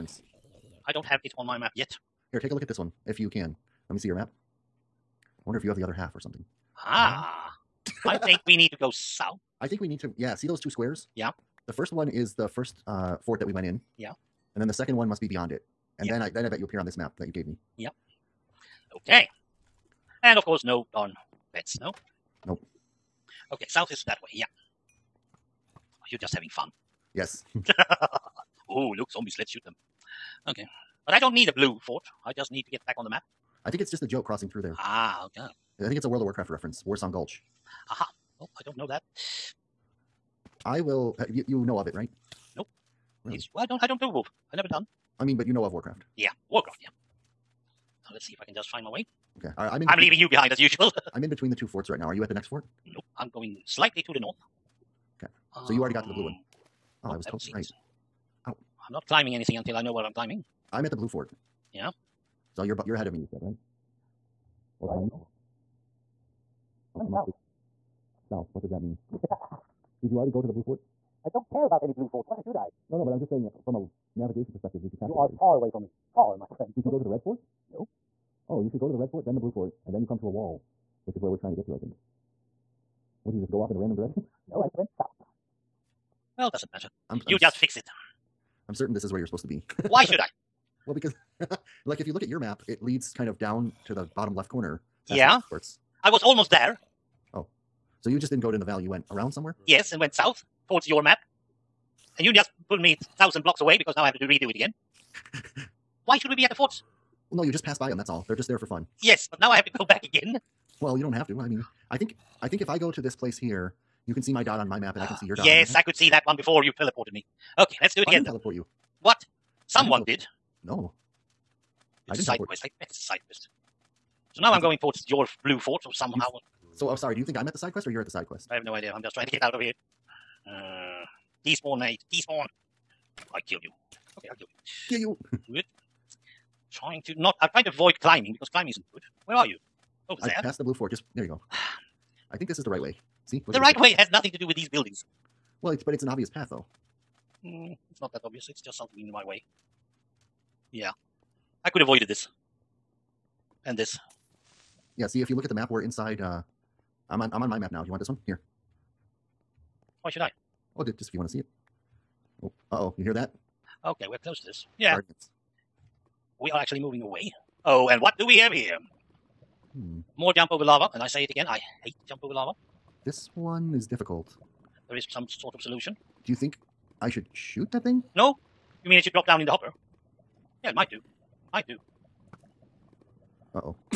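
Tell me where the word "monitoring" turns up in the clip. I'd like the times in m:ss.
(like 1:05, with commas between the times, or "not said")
not said.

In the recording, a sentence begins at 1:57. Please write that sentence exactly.
Okay, let's do it I again.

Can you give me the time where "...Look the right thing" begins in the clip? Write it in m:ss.
2:23.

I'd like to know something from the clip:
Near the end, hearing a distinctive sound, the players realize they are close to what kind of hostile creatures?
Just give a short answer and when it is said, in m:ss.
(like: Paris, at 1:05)
Guardians, at 2:44.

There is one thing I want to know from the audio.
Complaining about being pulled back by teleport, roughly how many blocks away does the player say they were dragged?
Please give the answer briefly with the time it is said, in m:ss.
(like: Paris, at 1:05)
thousand blocks, at 1:43.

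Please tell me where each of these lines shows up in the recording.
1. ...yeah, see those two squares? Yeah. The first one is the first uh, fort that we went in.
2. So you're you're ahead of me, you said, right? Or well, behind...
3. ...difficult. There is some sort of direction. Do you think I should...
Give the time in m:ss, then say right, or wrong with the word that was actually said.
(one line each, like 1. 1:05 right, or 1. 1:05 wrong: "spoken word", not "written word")
1. 0:10 right
2. 1:02 right
3. 2:53 wrong: "solution", not "direction".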